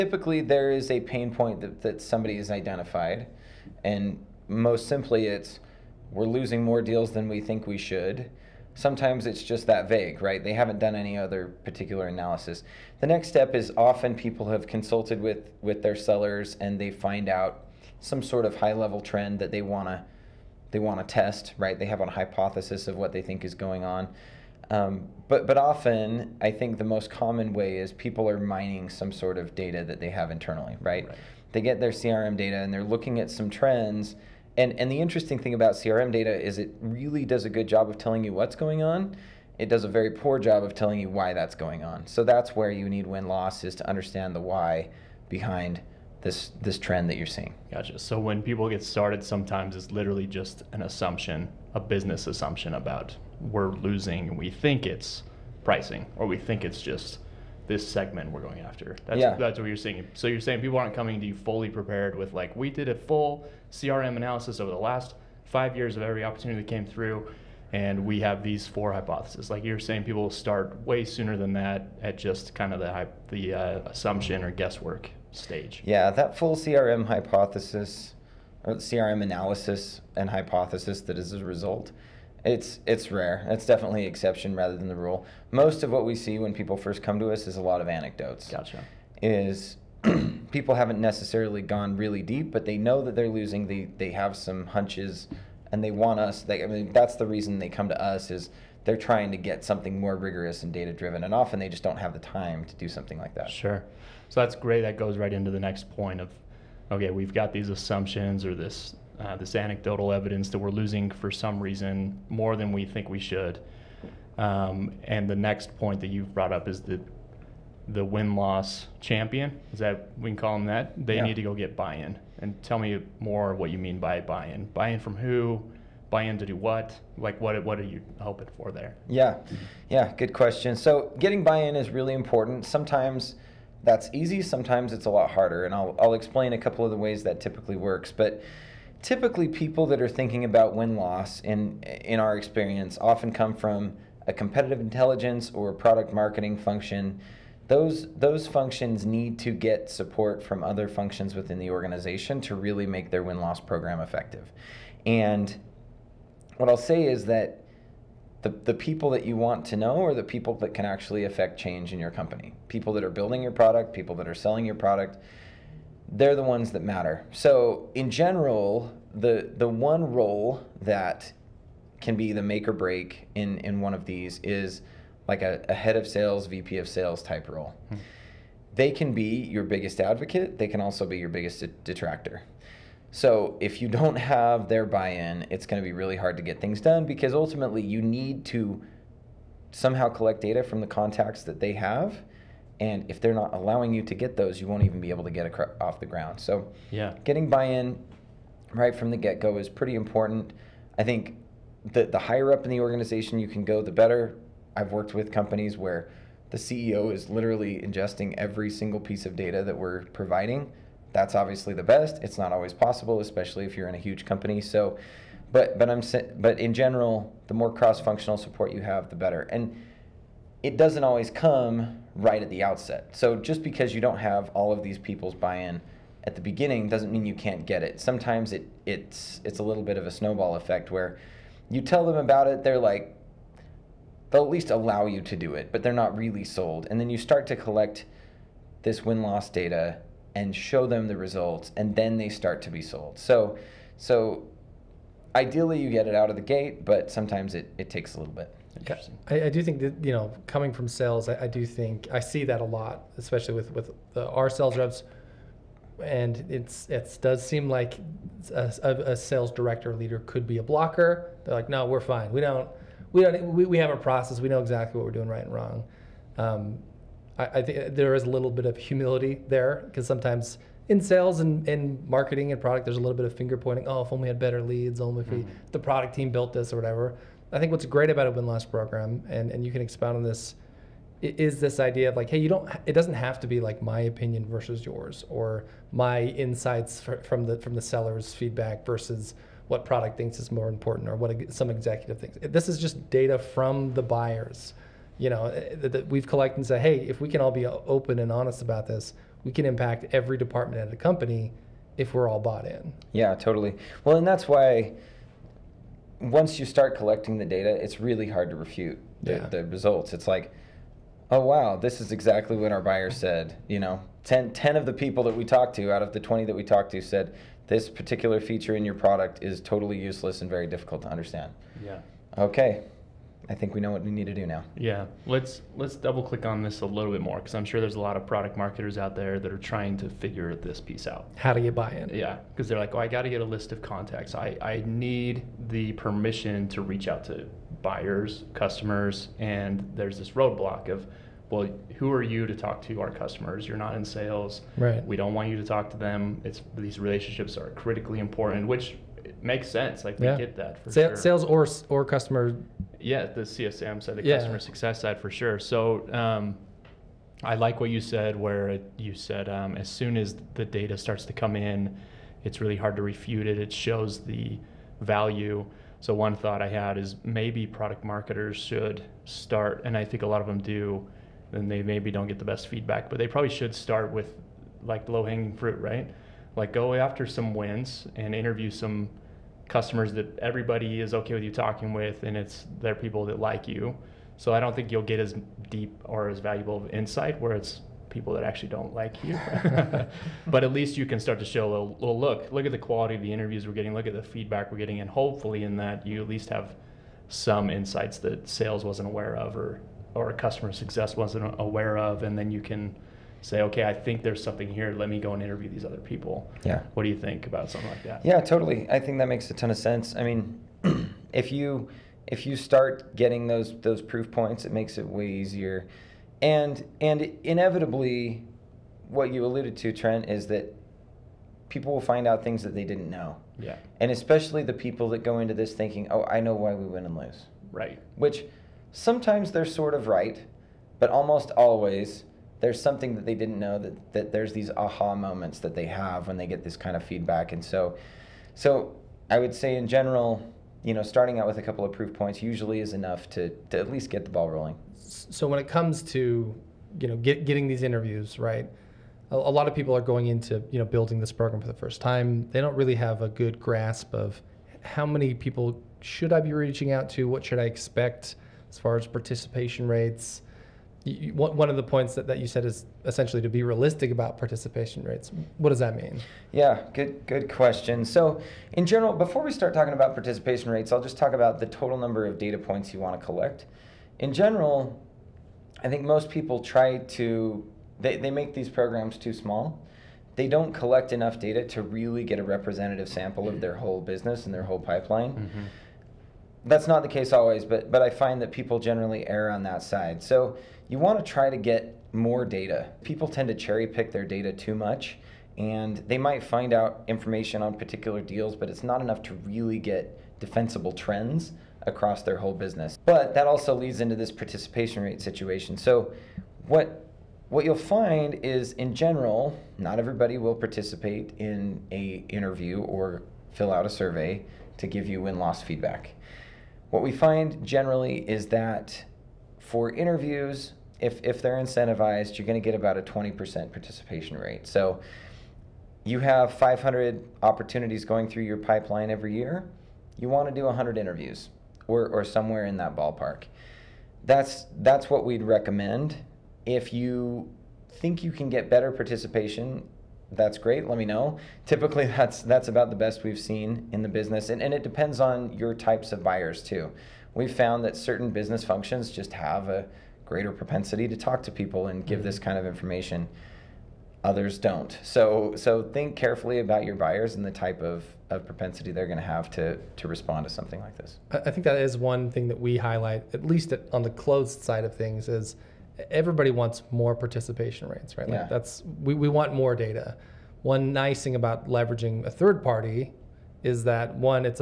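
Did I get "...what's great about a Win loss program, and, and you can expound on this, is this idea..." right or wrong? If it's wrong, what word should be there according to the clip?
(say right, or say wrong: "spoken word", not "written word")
right.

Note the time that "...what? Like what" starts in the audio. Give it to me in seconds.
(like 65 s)
126 s.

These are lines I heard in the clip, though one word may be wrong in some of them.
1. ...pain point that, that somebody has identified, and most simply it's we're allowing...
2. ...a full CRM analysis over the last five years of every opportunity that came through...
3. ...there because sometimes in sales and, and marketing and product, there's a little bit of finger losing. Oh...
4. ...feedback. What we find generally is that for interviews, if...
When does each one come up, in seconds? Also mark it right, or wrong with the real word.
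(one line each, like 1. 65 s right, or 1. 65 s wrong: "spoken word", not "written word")
1. 1 s wrong: "losing", not "allowing"
2. 62 s right
3. 269 s wrong: "pointing", not "losing"
4. 515 s right.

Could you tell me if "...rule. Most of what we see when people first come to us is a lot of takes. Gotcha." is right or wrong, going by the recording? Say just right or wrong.
wrong.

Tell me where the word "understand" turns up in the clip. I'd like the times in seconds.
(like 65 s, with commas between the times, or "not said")
43 s, 321 s.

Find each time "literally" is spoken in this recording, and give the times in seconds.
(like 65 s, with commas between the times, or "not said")
49 s, 207 s.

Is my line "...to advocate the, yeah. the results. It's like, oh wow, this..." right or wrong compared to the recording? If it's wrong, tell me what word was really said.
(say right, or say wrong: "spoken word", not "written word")
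wrong: "refute", not "advocate".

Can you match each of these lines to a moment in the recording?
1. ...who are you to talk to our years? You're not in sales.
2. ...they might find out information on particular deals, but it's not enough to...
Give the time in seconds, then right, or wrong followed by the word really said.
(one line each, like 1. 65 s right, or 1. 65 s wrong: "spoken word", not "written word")
1. 341 s wrong: "customers", not "years"
2. 496 s right.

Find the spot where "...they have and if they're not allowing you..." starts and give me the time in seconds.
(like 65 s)
191 s.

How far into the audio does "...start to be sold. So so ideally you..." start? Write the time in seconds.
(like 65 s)
242 s.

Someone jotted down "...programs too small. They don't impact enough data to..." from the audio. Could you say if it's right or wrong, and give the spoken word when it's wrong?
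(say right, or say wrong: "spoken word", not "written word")
wrong: "collect", not "impact".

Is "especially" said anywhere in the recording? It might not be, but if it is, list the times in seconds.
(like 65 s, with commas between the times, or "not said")
213 s, 253 s, 424 s.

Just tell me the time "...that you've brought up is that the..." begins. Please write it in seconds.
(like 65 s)
116 s.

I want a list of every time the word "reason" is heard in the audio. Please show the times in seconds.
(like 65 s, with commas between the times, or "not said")
97 s, 111 s.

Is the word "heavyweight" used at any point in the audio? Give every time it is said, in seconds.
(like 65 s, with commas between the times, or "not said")
not said.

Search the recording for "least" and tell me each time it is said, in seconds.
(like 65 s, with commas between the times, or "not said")
234 s, 390 s, 396 s, 443 s, 563 s.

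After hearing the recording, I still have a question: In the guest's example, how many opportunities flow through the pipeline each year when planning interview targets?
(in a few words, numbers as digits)
500.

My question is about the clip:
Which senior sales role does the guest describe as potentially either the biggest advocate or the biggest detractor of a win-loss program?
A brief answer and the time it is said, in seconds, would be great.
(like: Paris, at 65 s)
VP of sales, at 176 s.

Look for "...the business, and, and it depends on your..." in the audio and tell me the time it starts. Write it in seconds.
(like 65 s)
544 s.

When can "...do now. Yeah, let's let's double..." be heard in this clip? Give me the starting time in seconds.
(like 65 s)
324 s.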